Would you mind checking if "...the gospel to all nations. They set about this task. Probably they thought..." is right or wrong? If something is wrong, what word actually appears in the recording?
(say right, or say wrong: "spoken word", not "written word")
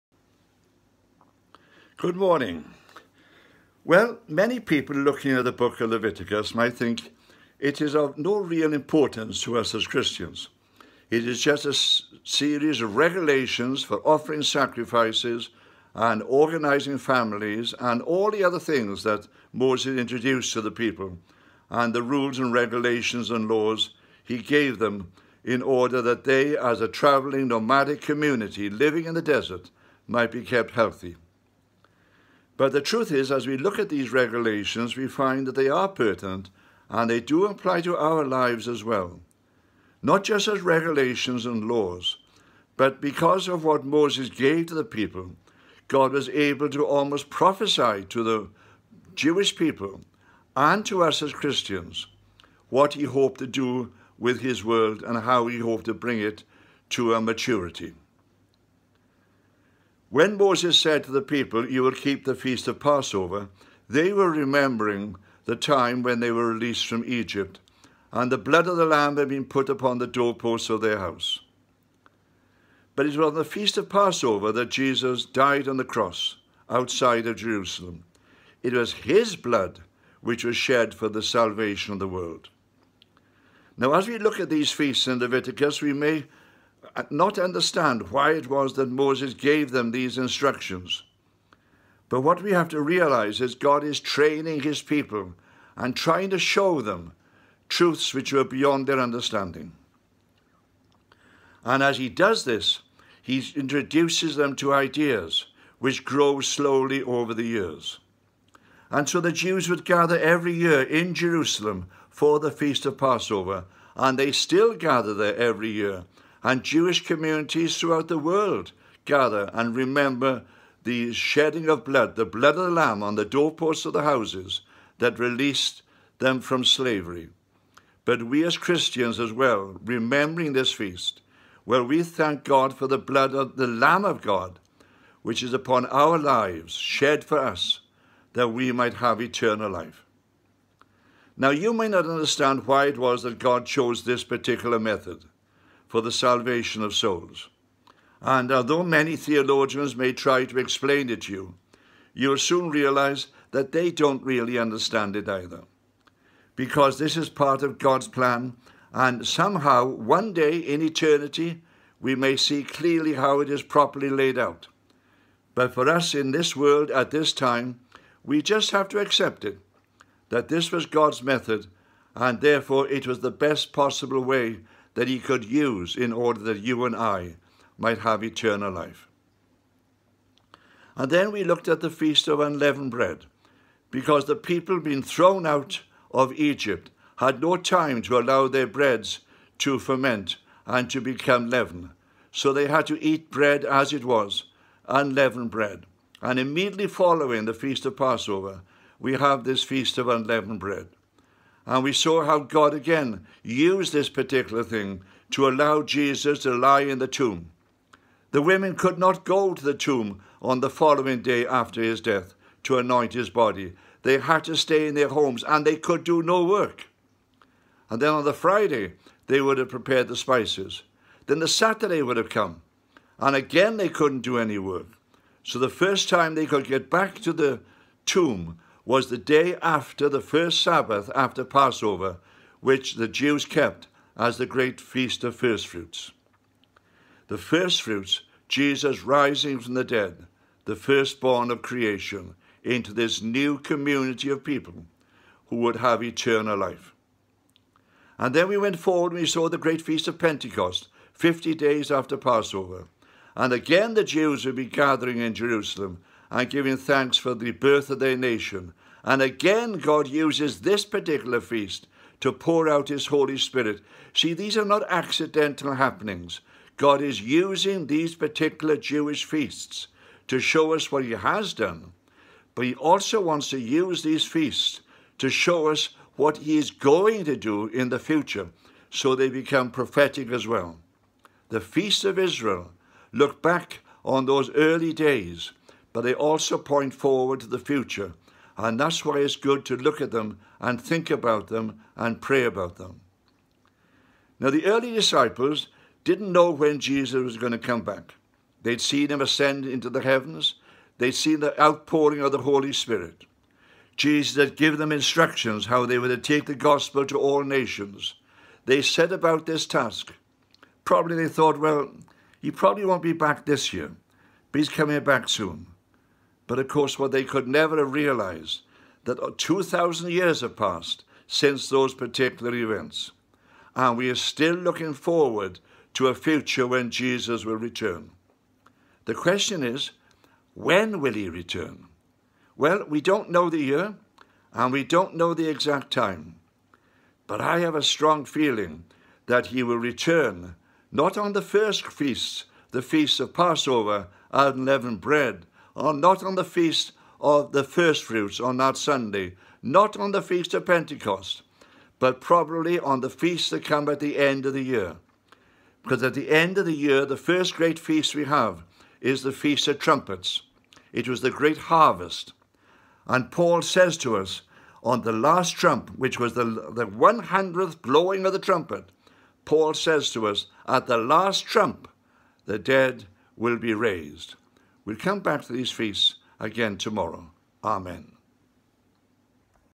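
right.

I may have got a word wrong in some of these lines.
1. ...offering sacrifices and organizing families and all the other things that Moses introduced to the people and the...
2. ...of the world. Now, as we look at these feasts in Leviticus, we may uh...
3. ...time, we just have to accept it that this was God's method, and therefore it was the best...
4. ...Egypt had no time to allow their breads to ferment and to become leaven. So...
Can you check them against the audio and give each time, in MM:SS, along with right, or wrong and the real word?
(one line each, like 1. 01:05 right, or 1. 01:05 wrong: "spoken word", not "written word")
1. 00:14 right
2. 01:21 right
3. 02:47 right
4. 03:06 right.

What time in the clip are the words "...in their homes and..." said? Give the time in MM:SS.
03:34.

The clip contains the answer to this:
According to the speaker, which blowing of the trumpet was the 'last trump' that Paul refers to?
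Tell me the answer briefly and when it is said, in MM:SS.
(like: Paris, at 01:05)
The 100th, at 06:06.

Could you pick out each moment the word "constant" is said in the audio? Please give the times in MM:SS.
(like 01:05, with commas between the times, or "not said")
not said.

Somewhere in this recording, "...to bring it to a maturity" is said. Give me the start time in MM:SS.
00:55.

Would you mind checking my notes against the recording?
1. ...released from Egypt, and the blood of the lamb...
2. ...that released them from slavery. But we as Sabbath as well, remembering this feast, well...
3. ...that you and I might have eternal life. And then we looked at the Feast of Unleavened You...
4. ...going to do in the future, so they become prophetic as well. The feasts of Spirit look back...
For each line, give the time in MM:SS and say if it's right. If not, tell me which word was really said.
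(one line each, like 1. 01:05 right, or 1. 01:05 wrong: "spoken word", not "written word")
1. 01:06 right
2. 02:04 wrong: "Christians", not "Sabbath"
3. 02:56 wrong: "Bread", not "You"
4. 04:36 wrong: "Israel", not "Spirit".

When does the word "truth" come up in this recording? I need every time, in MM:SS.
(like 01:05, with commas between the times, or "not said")
00:32, 01:37.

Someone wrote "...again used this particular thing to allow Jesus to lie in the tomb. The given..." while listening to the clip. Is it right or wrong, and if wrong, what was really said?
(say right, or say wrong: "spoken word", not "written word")
wrong: "women", not "given".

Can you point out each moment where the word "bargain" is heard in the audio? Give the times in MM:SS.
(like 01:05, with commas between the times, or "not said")
not said.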